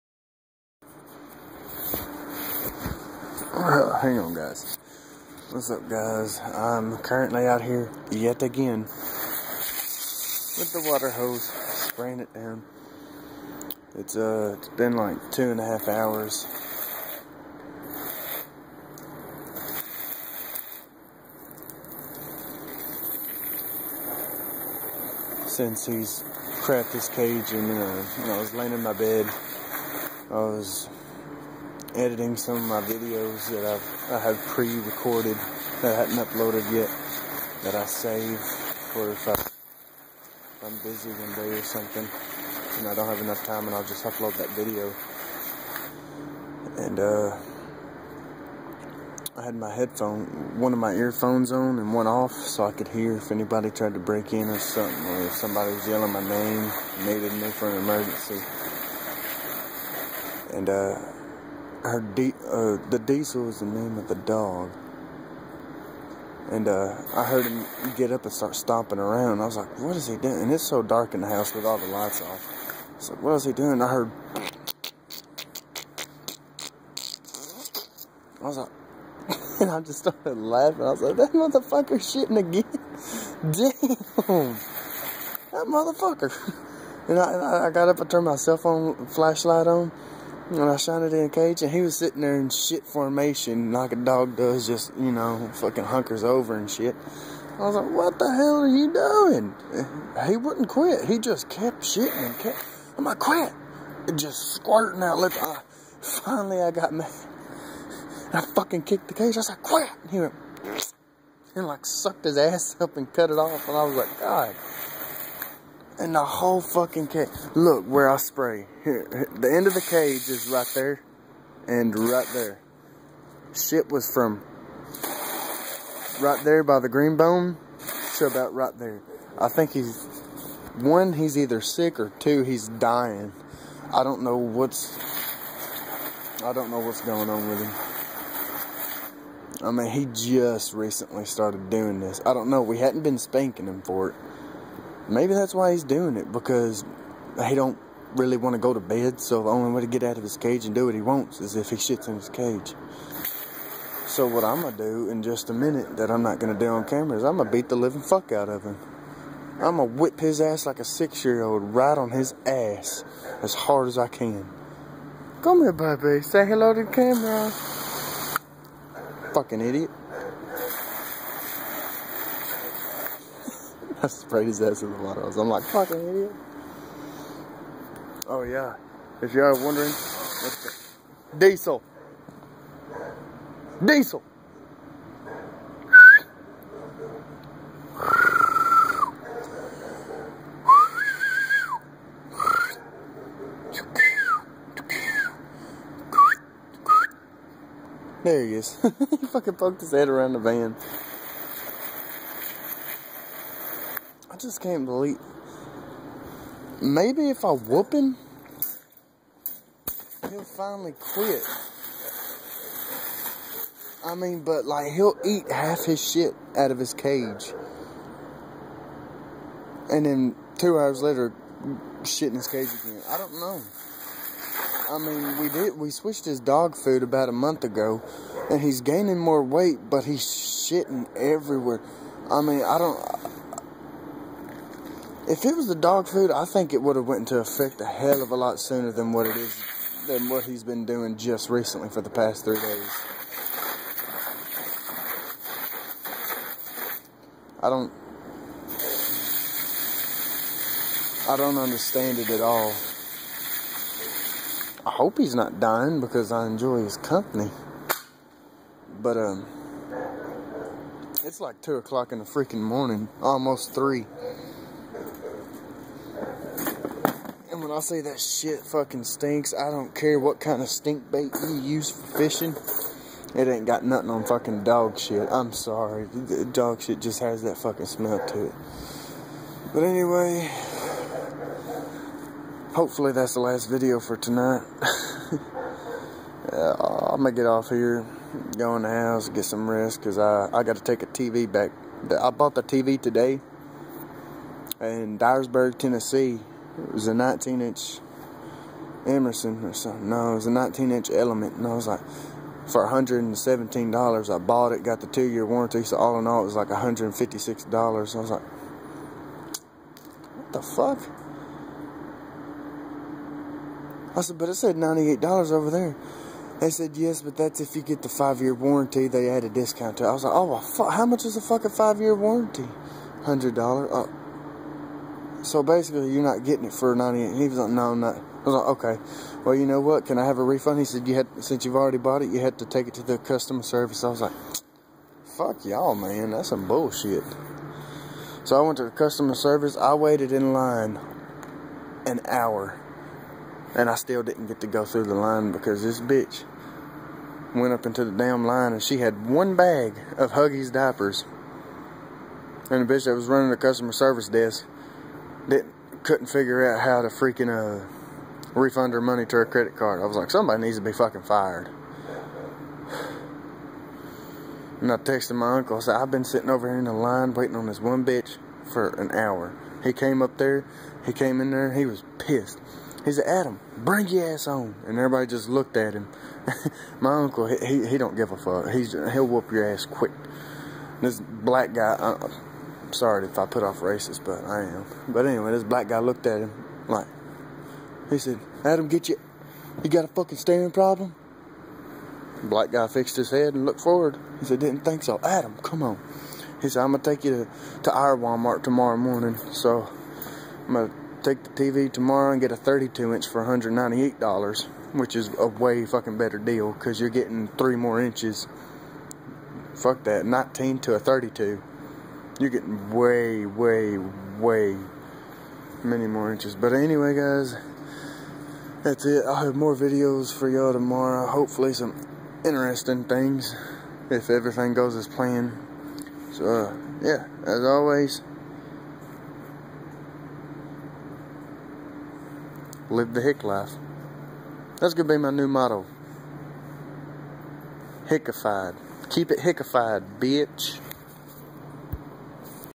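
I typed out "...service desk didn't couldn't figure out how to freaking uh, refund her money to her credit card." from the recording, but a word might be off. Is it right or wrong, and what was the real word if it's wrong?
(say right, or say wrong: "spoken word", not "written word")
right.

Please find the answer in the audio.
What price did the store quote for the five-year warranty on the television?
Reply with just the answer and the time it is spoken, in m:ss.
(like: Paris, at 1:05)
$100, at 5:23.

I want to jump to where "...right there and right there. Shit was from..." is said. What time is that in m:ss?
2:00.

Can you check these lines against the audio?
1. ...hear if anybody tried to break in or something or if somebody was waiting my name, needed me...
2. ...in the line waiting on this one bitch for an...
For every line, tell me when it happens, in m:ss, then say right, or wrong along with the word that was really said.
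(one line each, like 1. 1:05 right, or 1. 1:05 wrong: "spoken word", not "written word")
1. 0:52 wrong: "yelling", not "waiting"
2. 6:06 right.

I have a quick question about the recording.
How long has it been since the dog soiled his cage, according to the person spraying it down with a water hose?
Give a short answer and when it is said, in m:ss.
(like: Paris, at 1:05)
2 and a half hours, at 0:15.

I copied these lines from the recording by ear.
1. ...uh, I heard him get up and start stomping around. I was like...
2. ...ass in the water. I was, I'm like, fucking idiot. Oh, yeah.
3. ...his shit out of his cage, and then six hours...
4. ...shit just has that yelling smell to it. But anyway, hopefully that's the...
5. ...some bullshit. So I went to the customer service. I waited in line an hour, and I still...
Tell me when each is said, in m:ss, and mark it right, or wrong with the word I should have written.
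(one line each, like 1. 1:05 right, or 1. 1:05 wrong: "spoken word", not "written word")
1. 1:06 right
2. 2:54 right
3. 3:35 wrong: "two", not "six"
4. 4:36 wrong: "fucking", not "yelling"
5. 5:36 right.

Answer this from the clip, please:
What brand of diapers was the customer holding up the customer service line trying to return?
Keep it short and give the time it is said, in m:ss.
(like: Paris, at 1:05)
Huggies, at 5:50.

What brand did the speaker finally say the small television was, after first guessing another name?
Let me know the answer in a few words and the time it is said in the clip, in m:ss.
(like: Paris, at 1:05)
Element, at 5:01.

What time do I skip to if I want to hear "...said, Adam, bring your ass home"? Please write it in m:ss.
6:13.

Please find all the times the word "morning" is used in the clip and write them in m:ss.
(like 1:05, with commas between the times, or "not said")
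4:22, 6:38.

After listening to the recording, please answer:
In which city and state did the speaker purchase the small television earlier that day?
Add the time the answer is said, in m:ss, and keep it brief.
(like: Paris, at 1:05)
Dyersburg, Tennessee, at 4:55.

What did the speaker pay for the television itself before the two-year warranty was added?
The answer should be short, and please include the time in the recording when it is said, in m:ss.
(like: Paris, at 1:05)
$117, at 5:02.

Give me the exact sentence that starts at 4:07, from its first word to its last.
I don't I don't understand it at all.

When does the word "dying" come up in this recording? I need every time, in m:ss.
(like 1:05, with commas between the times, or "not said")
2:12, 4:15.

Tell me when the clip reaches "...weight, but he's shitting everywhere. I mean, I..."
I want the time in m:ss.
3:49.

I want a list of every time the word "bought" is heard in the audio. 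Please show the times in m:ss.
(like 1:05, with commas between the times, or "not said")
4:52, 5:04, 5:31.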